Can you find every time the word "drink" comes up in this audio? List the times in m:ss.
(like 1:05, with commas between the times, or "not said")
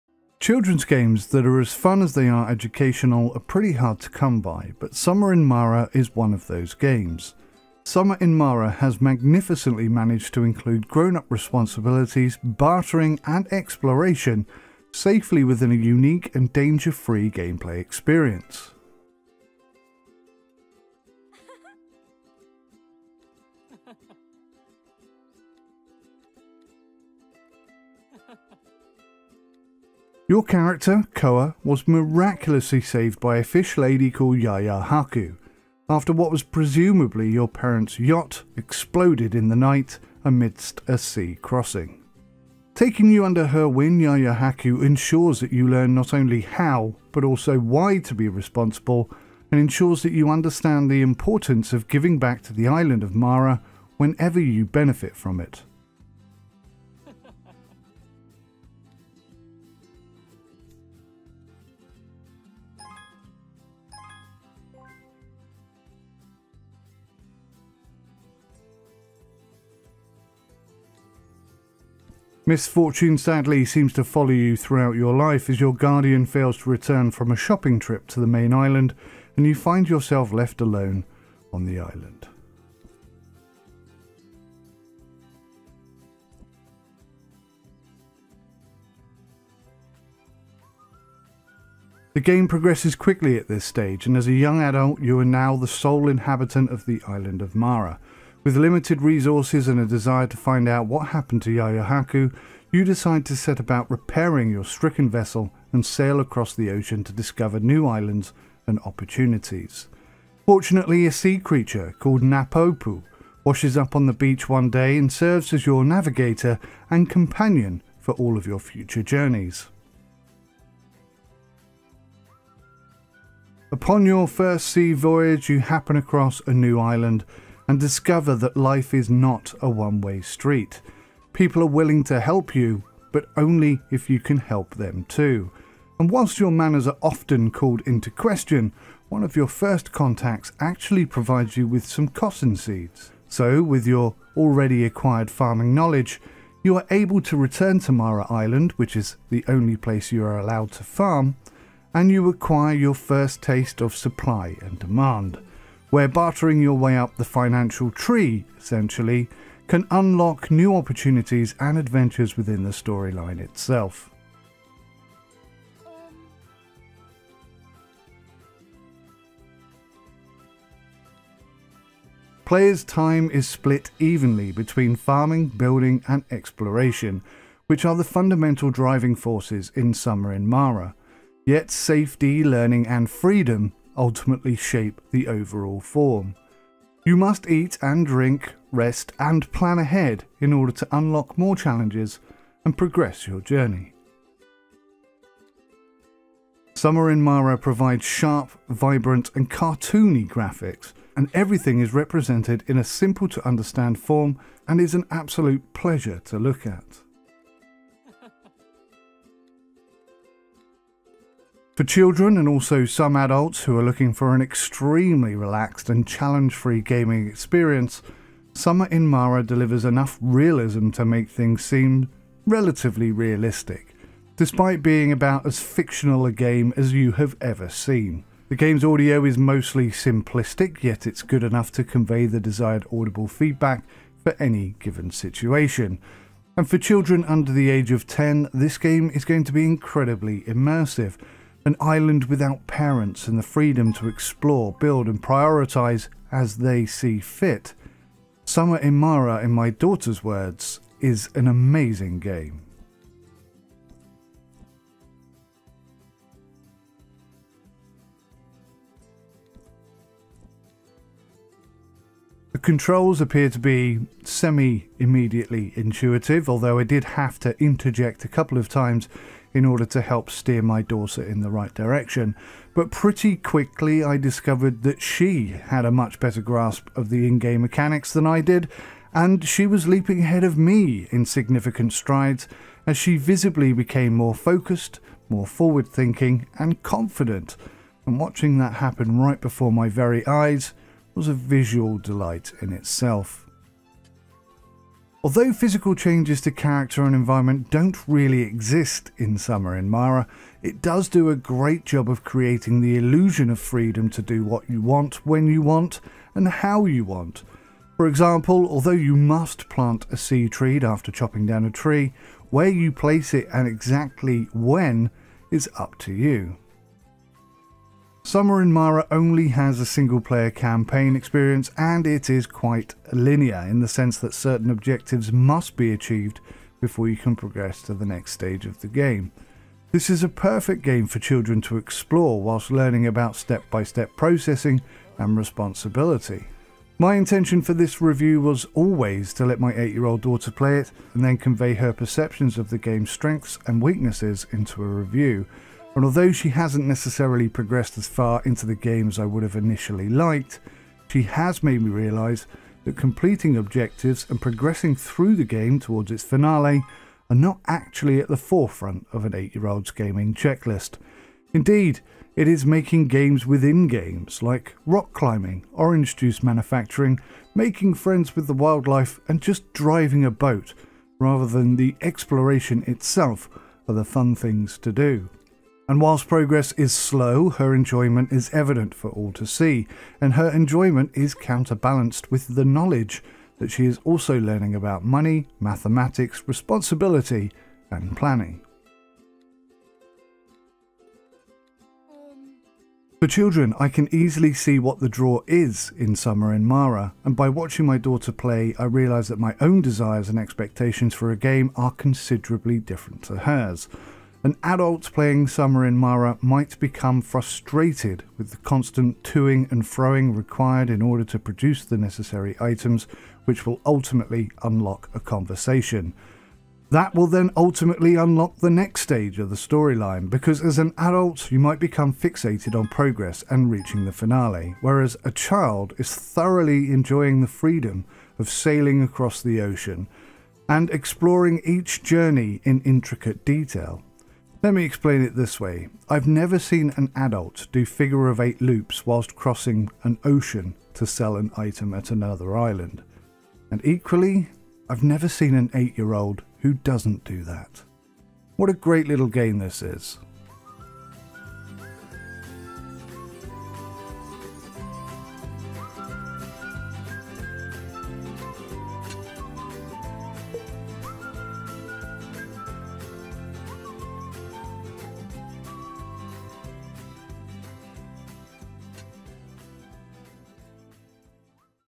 3:08.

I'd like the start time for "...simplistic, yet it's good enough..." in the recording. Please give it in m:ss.
3:49.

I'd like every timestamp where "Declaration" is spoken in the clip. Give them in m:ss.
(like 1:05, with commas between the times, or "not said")
not said.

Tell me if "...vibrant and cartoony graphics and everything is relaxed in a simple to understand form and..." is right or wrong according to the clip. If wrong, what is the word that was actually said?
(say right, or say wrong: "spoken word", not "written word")
wrong: "represented", not "relaxed".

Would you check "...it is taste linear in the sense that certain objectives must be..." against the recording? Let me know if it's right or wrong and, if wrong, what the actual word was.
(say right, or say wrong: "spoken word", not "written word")
wrong: "quite", not "taste".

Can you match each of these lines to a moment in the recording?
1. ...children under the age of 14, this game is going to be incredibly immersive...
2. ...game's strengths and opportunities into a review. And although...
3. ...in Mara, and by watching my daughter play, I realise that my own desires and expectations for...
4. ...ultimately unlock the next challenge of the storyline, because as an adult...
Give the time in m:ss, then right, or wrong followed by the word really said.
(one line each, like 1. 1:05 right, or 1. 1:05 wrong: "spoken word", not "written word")
1. 3:56 wrong: "10", not "14"
2. 5:42 wrong: "weaknesses", not "opportunities"
3. 6:36 right
4. 6:57 wrong: "stage", not "challenge".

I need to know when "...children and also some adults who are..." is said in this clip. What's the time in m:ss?
3:31.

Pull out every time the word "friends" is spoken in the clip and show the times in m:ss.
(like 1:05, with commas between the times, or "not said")
6:07.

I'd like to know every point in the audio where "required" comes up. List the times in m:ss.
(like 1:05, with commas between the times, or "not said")
6:50.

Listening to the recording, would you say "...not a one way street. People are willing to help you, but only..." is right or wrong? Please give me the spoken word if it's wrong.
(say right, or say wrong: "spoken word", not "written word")
right.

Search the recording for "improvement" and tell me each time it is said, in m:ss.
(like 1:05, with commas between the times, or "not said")
not said.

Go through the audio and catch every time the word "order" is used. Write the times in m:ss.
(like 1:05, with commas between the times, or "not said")
3:10, 4:29, 6:50.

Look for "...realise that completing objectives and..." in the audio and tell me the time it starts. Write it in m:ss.
5:51.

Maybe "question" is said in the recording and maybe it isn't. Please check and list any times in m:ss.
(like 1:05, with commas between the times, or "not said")
2:18.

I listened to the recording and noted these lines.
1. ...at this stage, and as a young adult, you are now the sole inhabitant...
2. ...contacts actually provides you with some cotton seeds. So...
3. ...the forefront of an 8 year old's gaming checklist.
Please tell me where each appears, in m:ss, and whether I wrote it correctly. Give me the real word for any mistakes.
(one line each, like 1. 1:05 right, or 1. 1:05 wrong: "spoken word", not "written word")
1. 1:33 right
2. 2:19 right
3. 5:58 right.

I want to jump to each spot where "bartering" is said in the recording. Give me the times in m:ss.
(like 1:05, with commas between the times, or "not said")
0:12, 2:36.